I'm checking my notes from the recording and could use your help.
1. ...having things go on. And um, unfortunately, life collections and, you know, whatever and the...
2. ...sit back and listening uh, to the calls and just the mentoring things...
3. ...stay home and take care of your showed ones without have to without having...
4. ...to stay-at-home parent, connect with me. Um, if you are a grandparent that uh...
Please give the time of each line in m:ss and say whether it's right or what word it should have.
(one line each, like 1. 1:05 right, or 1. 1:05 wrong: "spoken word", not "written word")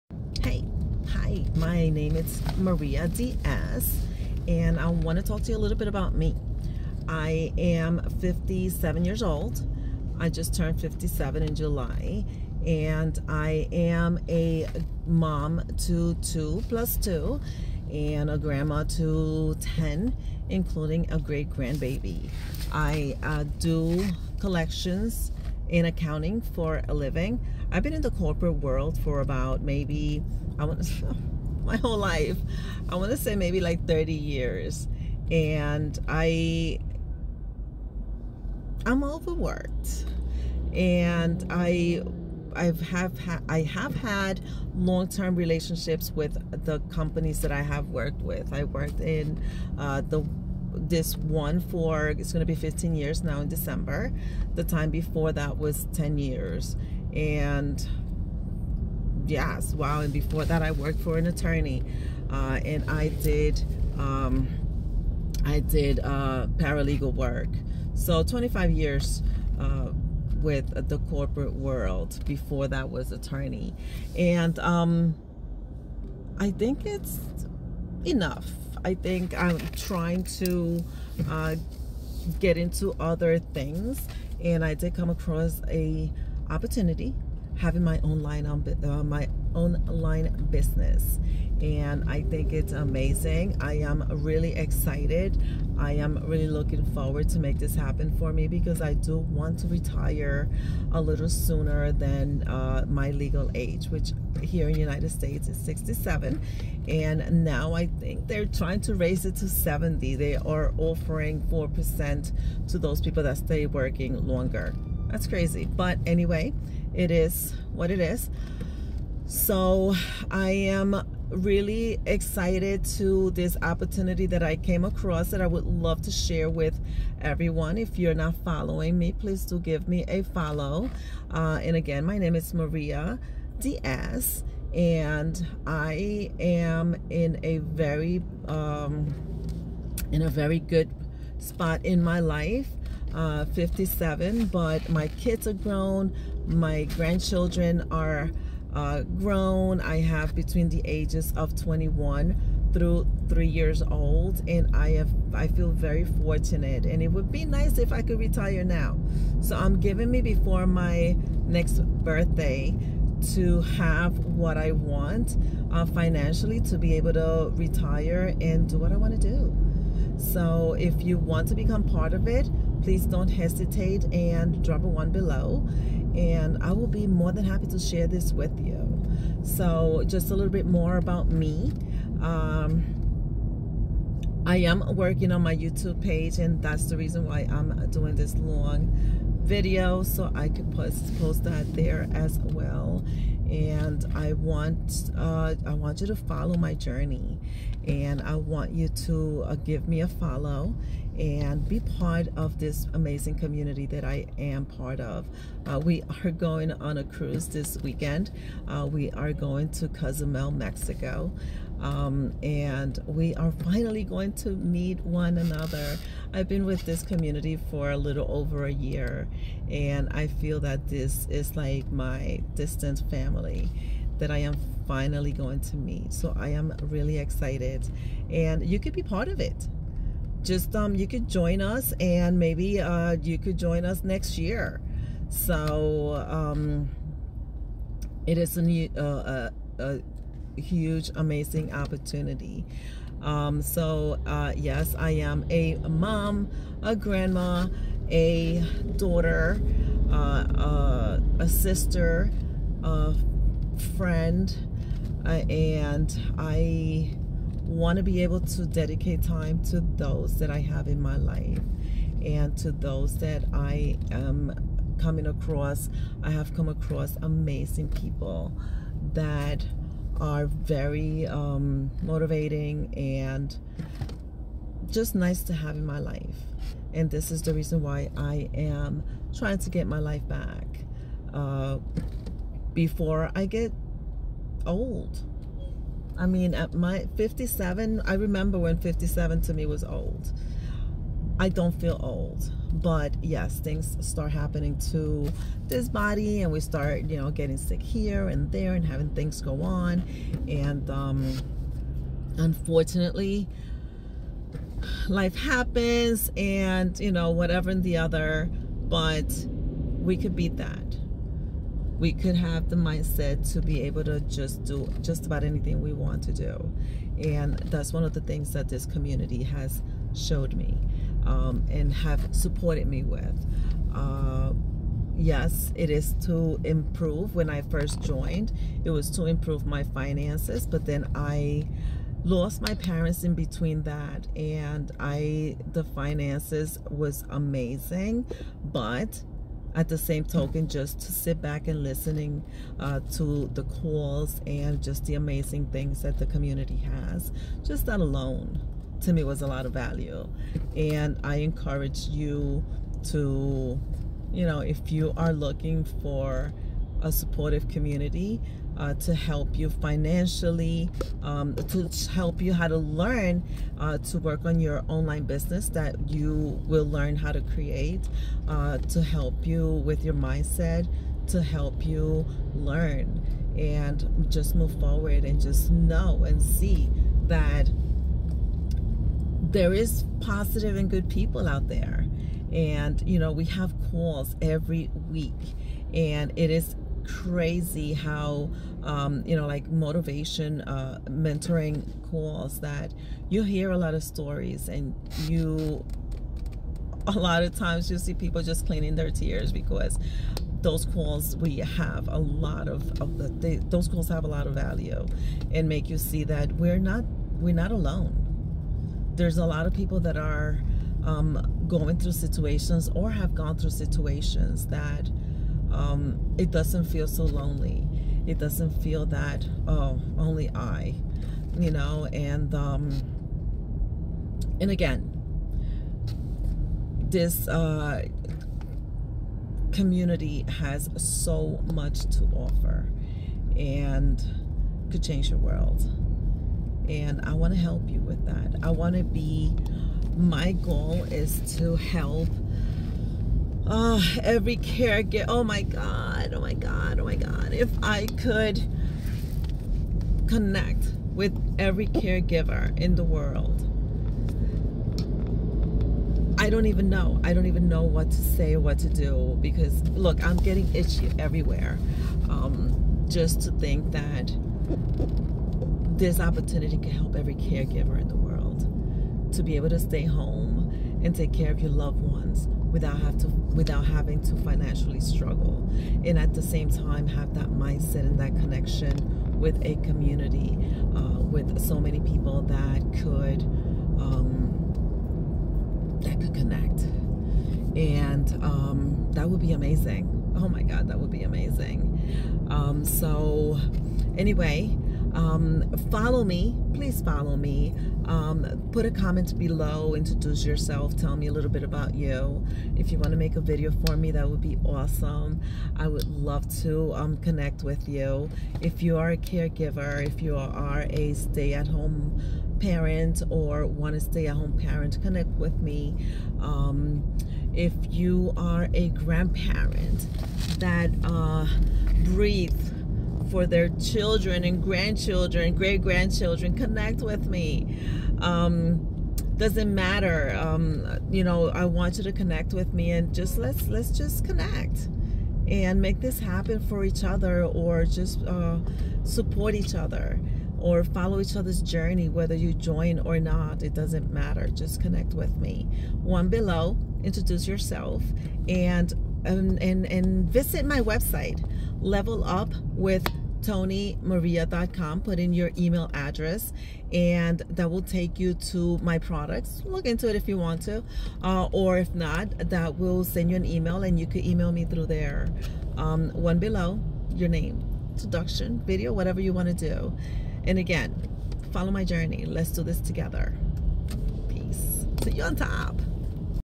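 1. 4:58 wrong: "happens", not "collections"
2. 5:41 wrong: "amazing", not "mentoring"
3. 7:49 wrong: "loved", not "showed"
4. 8:33 right.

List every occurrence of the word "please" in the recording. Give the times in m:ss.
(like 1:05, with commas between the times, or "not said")
2:09, 2:52, 8:16.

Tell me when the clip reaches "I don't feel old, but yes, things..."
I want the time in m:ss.
4:51.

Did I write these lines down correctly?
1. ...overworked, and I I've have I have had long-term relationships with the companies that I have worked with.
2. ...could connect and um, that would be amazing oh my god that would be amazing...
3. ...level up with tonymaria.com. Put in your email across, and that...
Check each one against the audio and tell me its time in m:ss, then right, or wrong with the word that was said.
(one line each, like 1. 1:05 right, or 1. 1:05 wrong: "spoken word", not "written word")
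1. 0:39 right
2. 8:06 right
3. 9:11 wrong: "address", not "across".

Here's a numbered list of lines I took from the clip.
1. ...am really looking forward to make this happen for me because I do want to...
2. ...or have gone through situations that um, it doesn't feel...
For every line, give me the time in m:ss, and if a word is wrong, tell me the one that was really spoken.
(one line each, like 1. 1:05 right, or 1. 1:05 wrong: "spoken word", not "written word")
1. 1:35 right
2. 6:52 right.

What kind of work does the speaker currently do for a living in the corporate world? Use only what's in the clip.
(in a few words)
Collections in accounting.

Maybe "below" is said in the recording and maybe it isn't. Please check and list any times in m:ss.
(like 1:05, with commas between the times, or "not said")
2:55, 8:19, 9:06, 9:26.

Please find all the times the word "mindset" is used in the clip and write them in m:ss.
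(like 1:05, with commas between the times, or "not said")
5:12, 6:10, 7:57.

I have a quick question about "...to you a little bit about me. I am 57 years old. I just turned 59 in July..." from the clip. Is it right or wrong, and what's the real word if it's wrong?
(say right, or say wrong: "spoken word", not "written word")
wrong: "57", not "59".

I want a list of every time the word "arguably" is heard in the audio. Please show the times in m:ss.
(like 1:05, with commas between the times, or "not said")
not said.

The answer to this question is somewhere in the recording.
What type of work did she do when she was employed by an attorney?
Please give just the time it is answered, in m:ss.
1:06.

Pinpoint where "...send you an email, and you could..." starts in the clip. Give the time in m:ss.
9:23.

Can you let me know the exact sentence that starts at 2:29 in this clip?
I have between the ages of 21 through three years old, and I have I feel very fortunate.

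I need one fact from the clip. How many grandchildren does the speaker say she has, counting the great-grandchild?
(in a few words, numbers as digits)
10.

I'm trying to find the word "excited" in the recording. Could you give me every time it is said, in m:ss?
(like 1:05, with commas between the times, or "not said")
1:34, 2:02, 3:47.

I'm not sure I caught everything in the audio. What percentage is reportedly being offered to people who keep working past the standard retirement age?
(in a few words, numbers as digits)
4%.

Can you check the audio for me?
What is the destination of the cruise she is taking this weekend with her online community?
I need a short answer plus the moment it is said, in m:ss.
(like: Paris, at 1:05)
Cozumel, Mexico, at 3:29.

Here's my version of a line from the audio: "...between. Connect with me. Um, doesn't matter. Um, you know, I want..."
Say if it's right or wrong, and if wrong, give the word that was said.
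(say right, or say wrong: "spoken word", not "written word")
wrong: "grandchildren", not "between".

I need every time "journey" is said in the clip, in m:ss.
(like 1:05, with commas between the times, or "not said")
3:16, 9:01, 9:31.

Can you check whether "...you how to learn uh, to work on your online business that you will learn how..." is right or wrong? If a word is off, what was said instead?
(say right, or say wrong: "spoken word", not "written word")
right.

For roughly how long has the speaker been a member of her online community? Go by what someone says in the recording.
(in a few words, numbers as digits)
A little over a year.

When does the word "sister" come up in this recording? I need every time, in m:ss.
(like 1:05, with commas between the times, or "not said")
4:11.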